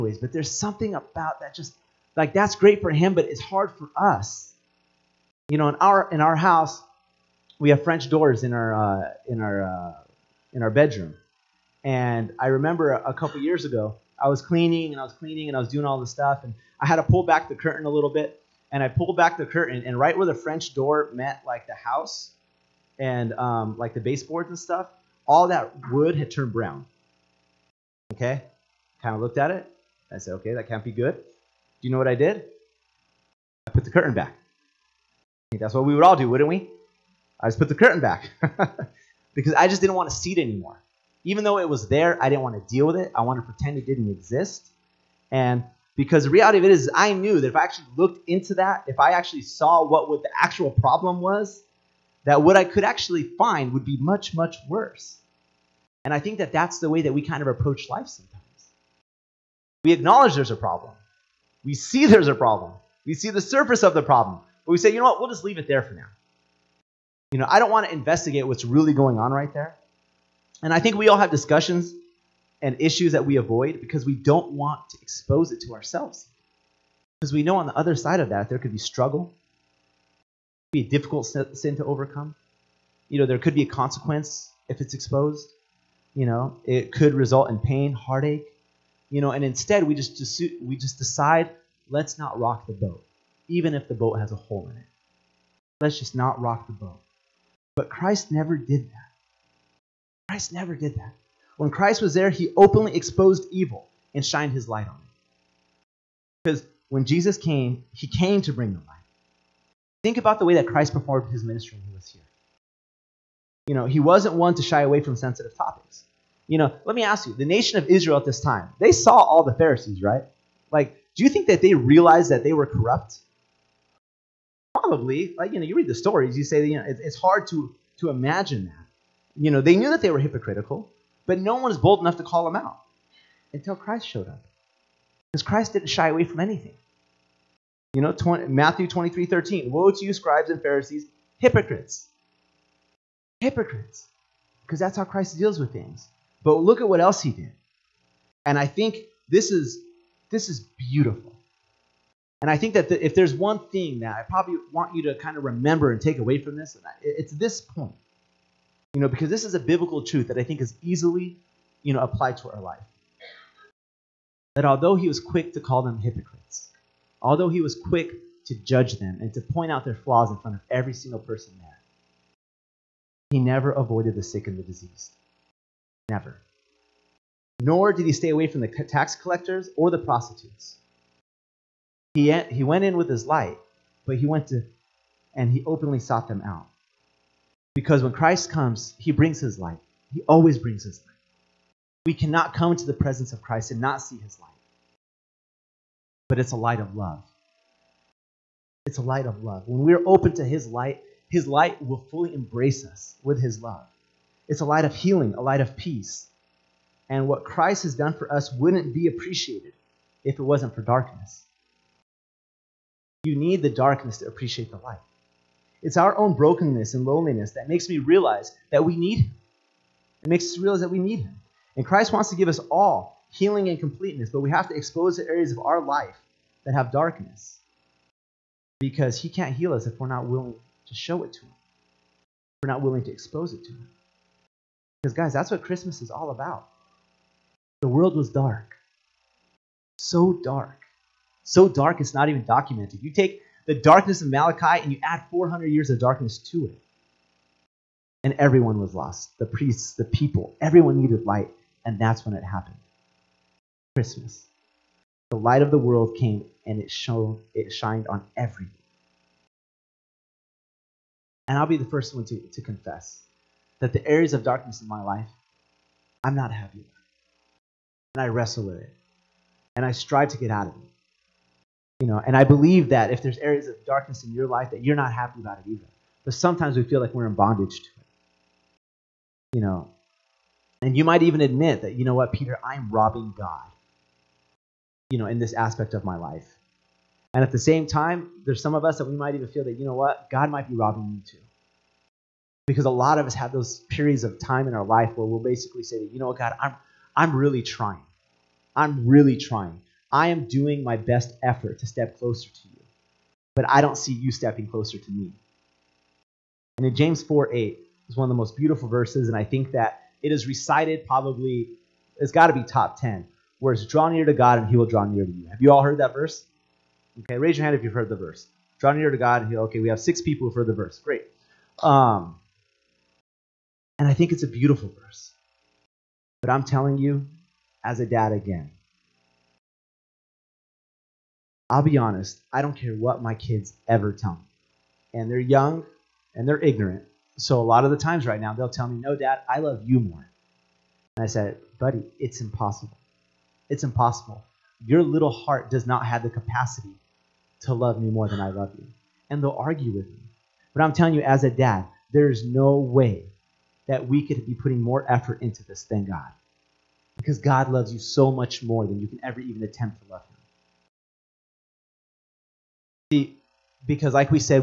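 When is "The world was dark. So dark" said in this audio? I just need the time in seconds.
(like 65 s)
237 s.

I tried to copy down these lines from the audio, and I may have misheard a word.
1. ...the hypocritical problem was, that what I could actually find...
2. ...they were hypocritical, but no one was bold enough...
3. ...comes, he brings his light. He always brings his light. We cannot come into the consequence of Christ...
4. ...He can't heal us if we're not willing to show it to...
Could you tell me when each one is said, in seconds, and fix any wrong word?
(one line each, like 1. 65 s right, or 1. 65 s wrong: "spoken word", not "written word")
1. 50 s wrong: "actual", not "hypocritical"
2. 130 s right
3. 188 s wrong: "presence", not "consequence"
4. 229 s right.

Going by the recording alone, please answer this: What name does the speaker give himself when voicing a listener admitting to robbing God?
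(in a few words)
Peter.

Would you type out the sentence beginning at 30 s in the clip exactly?
I said, okay, that can't be good.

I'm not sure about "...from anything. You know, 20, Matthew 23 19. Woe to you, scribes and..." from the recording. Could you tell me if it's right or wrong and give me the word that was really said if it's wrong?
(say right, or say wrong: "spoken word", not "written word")
wrong: "13", not "19".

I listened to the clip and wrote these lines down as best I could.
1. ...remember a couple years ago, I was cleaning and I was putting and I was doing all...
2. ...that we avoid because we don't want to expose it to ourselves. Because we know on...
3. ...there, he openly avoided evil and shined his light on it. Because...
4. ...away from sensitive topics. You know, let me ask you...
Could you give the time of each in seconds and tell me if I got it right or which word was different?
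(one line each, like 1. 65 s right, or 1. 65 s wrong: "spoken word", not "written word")
1. 12 s wrong: "cleaning", not "putting"
2. 73 s right
3. 102 s wrong: "exposed", not "avoided"
4. 114 s right.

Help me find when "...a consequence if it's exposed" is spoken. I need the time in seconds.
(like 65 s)
83 s.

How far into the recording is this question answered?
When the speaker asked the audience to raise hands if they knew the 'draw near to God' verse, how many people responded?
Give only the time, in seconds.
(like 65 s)
320 s.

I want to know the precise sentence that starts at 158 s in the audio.
You know, because this is a biblical truth that I think is easily, you know, applied to our life.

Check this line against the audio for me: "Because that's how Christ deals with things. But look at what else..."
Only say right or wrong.
right.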